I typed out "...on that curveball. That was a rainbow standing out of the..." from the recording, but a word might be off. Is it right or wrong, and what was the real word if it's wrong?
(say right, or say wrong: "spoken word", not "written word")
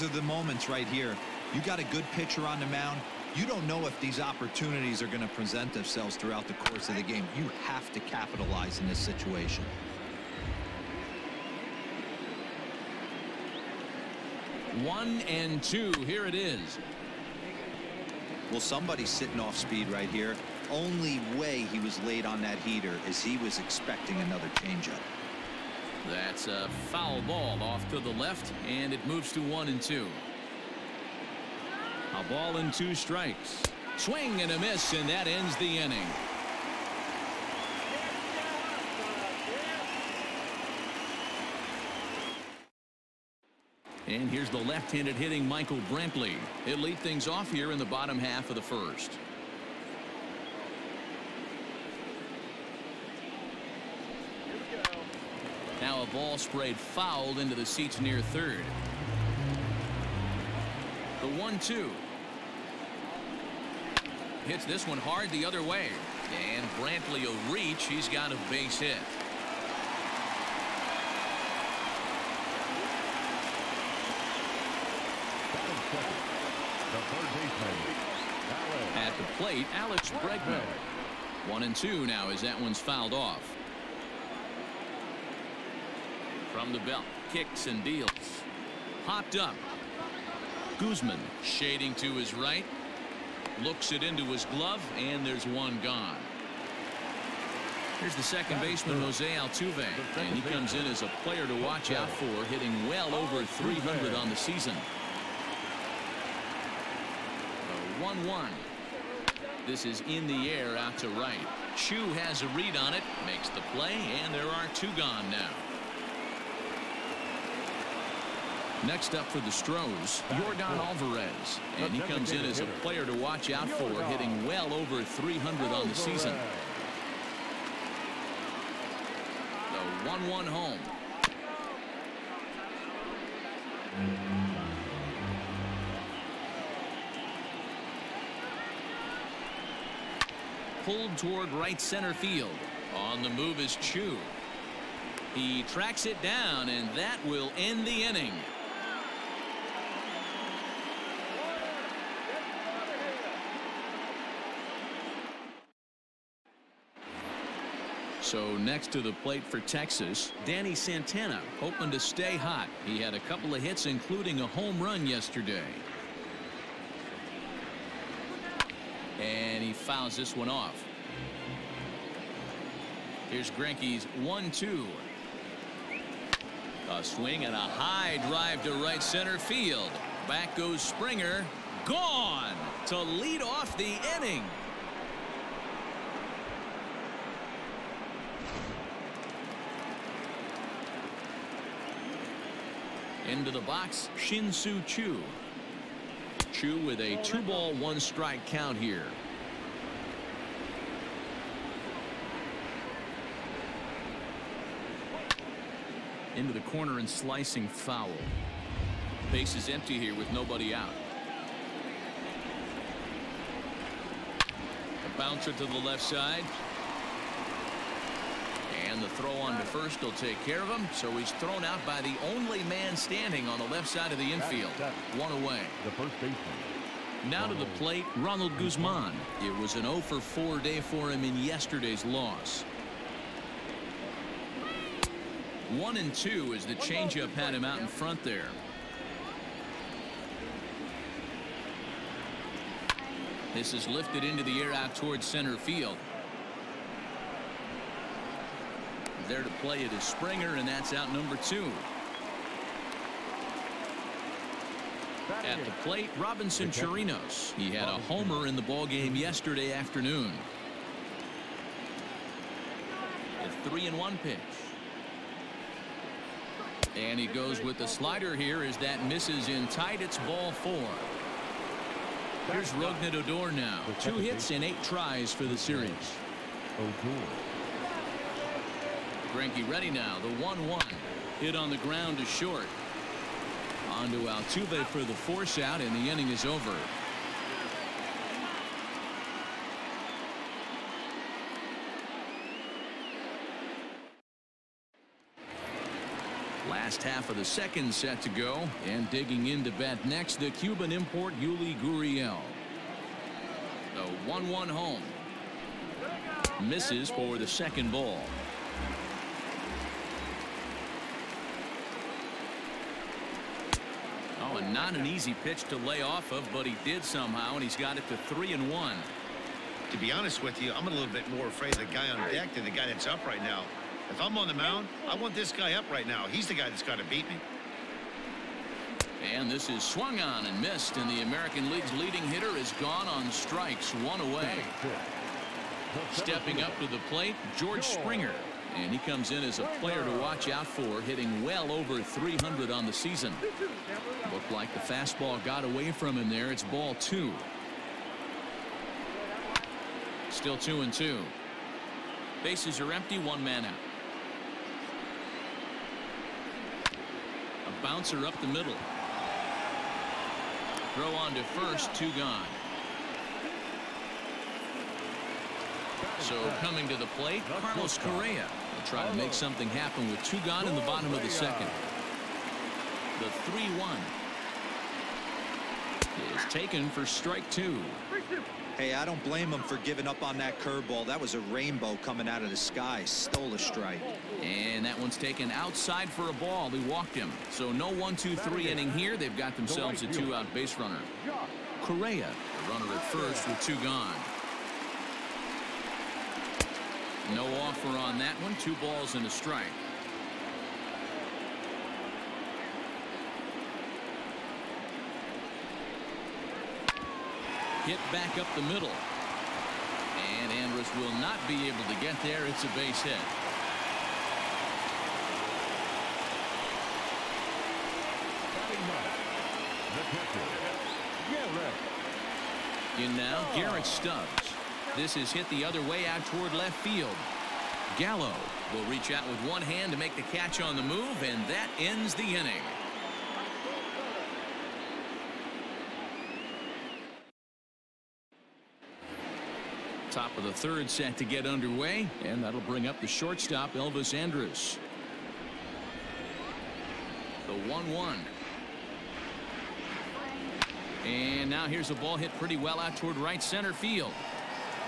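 wrong: "coming", not "standing".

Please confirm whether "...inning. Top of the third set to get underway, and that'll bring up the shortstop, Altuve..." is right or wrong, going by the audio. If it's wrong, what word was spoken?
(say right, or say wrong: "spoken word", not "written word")
wrong: "Elvis", not "Altuve".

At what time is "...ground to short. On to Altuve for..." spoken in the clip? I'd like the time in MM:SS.
04:41.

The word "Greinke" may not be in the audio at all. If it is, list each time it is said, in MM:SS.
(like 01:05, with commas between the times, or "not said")
02:53, 04:39.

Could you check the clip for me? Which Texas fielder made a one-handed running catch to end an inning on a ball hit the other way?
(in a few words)
Gallo.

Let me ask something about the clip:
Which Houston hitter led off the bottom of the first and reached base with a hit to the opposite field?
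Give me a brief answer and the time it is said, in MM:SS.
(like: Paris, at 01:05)
Michael Brantley, at 00:45.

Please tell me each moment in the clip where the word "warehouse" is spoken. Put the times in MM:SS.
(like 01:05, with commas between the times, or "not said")
not said.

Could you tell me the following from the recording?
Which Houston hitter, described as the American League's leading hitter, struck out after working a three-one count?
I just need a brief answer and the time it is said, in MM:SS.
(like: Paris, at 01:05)
Yuli Gurriel, at 05:01.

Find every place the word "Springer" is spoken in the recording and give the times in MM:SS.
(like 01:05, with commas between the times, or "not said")
03:00, 04:10, 05:37.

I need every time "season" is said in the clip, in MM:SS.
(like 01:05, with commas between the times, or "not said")
01:44, 02:05, 05:42.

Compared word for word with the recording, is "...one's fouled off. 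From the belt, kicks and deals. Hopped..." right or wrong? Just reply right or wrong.
right.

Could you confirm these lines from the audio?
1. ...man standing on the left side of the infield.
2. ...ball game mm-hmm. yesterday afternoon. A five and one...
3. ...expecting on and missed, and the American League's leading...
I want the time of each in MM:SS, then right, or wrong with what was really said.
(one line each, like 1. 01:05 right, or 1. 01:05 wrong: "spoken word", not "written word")
1. 03:42 right
2. 04:18 wrong: "three", not "five"
3. 05:29 wrong: "swung", not "expecting".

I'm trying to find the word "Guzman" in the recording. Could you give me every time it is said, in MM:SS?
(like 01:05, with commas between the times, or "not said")
01:30, 03:48.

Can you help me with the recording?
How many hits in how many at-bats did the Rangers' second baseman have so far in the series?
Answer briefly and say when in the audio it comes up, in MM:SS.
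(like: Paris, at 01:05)
2 hits in 8 tries, at 04:34.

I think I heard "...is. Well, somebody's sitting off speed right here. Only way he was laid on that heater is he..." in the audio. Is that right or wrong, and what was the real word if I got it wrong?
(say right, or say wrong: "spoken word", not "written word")
right.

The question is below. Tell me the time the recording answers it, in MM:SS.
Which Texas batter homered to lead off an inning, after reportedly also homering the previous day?
02:40.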